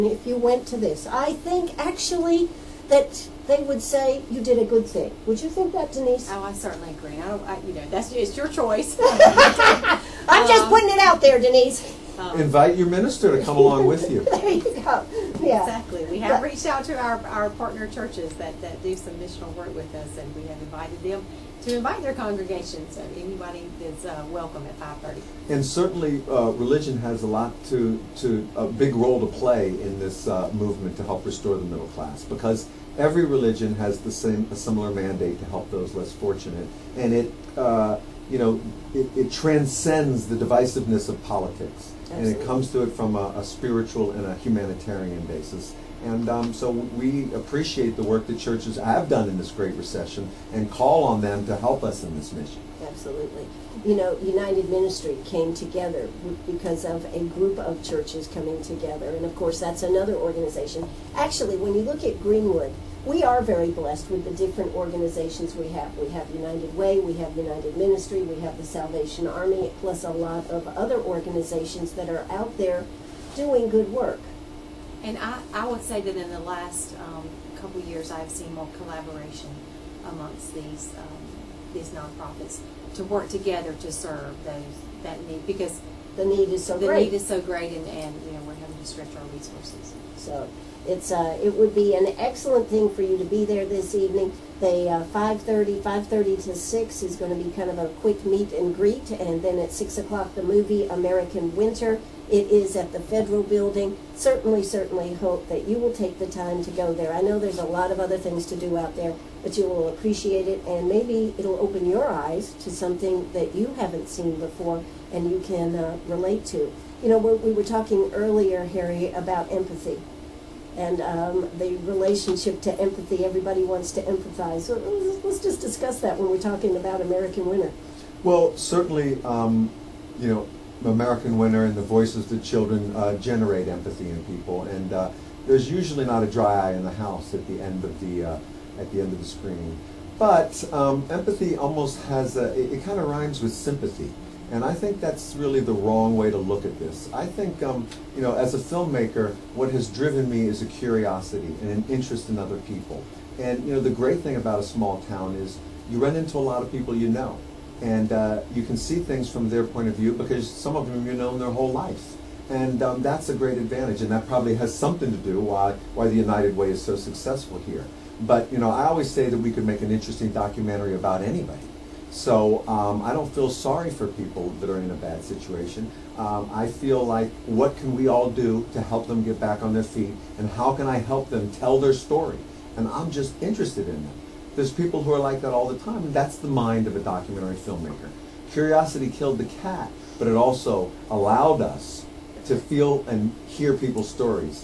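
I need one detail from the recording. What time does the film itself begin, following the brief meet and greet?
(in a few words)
6 o'clock.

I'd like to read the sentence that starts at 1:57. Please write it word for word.
You know, we we were talking earlier, Harry, about empathy and um, the relationship to empathy.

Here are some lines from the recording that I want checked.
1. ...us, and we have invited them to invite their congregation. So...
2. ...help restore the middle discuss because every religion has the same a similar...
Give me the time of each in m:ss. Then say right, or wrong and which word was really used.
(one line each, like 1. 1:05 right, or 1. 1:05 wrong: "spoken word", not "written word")
1. 0:19 right
2. 0:31 wrong: "class", not "discuss".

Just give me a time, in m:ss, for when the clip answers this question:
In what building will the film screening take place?
1:42.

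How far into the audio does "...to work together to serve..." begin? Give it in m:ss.
1:22.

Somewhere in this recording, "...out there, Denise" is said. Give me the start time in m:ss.
0:10.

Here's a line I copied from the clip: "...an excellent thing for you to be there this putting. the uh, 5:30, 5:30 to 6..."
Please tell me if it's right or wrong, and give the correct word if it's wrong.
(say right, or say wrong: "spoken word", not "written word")
wrong: "evening", not "putting".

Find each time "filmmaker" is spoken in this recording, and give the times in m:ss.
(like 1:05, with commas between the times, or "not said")
2:28, 3:07.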